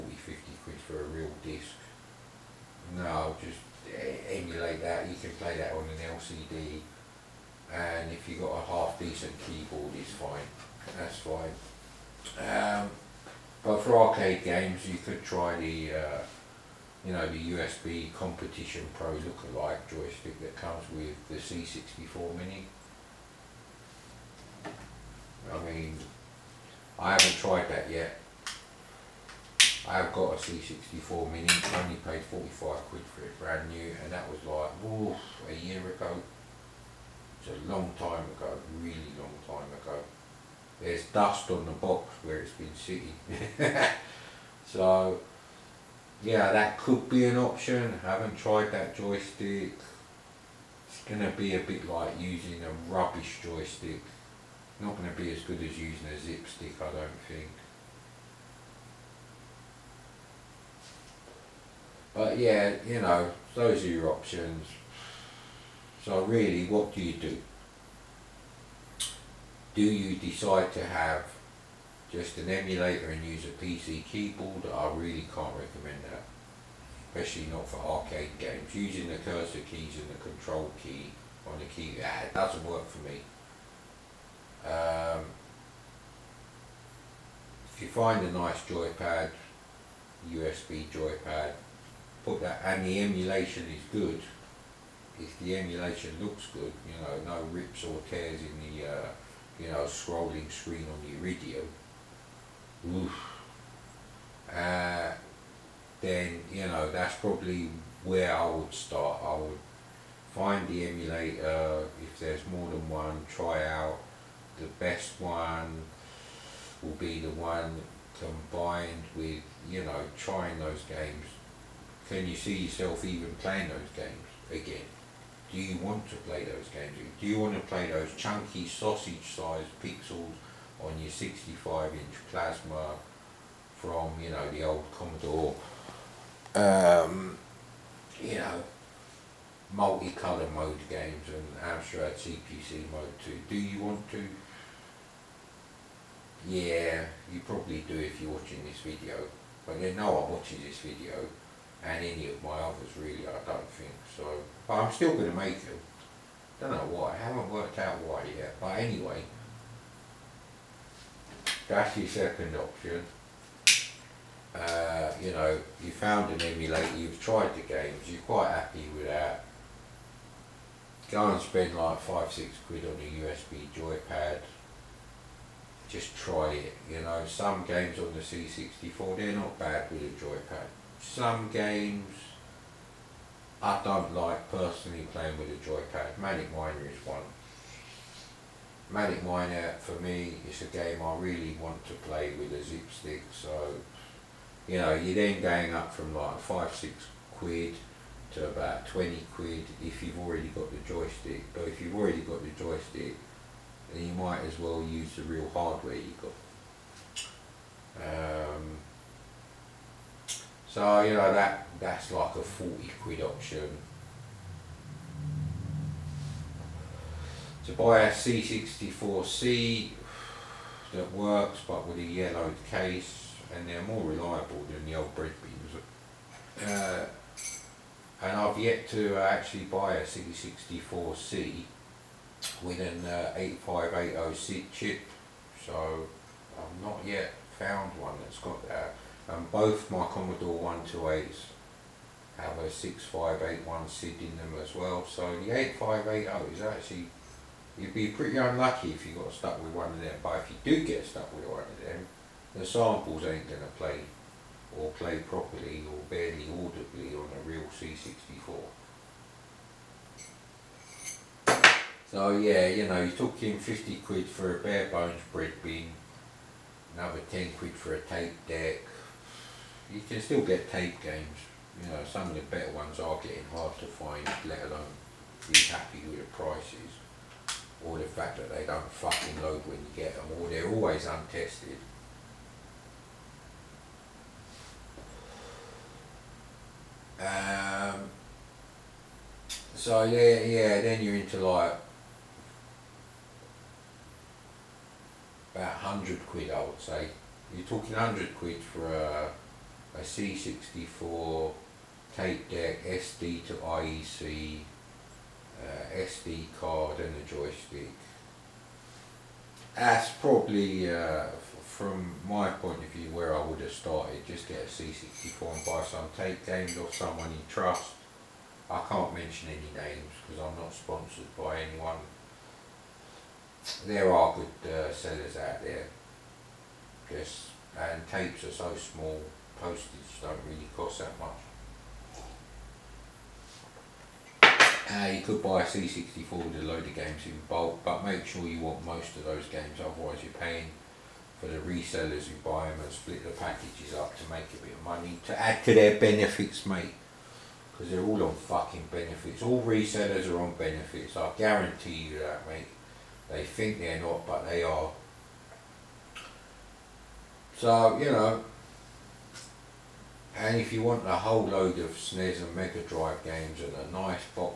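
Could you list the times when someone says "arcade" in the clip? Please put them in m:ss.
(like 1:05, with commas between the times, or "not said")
0:13, 1:17.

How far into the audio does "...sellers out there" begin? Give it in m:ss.
5:24.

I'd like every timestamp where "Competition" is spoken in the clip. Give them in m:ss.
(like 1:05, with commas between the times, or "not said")
0:18.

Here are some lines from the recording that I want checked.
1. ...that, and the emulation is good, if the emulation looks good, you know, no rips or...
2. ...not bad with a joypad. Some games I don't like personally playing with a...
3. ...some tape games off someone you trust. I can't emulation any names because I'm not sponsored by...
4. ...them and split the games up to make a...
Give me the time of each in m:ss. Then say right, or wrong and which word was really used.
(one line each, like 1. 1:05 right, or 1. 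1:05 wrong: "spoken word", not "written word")
1. 1:32 right
2. 2:59 right
3. 5:15 wrong: "mention", not "emulation"
4. 5:42 wrong: "packages", not "games".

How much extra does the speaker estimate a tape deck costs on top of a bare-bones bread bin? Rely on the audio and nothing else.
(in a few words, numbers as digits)
10 quid.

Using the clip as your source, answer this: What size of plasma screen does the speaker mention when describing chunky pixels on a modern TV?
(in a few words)
65-inch.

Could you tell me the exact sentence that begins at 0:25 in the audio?
I mean, I haven't tried that yet.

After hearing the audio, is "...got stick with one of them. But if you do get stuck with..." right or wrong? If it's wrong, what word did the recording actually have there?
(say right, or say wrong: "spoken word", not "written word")
wrong: "stuck", not "stick".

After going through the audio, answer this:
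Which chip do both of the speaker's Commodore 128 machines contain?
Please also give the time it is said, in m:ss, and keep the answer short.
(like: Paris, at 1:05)
6581 SID, at 4:02.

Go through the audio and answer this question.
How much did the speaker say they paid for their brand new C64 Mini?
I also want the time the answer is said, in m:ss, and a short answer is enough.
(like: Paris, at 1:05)
45 quid, at 0:32.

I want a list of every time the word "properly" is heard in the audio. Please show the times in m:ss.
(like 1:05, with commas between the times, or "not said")
4:15.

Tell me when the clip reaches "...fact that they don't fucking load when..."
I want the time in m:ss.
4:38.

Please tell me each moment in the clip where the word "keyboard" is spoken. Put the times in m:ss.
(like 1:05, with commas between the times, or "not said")
0:09, 1:14.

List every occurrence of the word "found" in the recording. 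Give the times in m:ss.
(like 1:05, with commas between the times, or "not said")
2:45, 3:57.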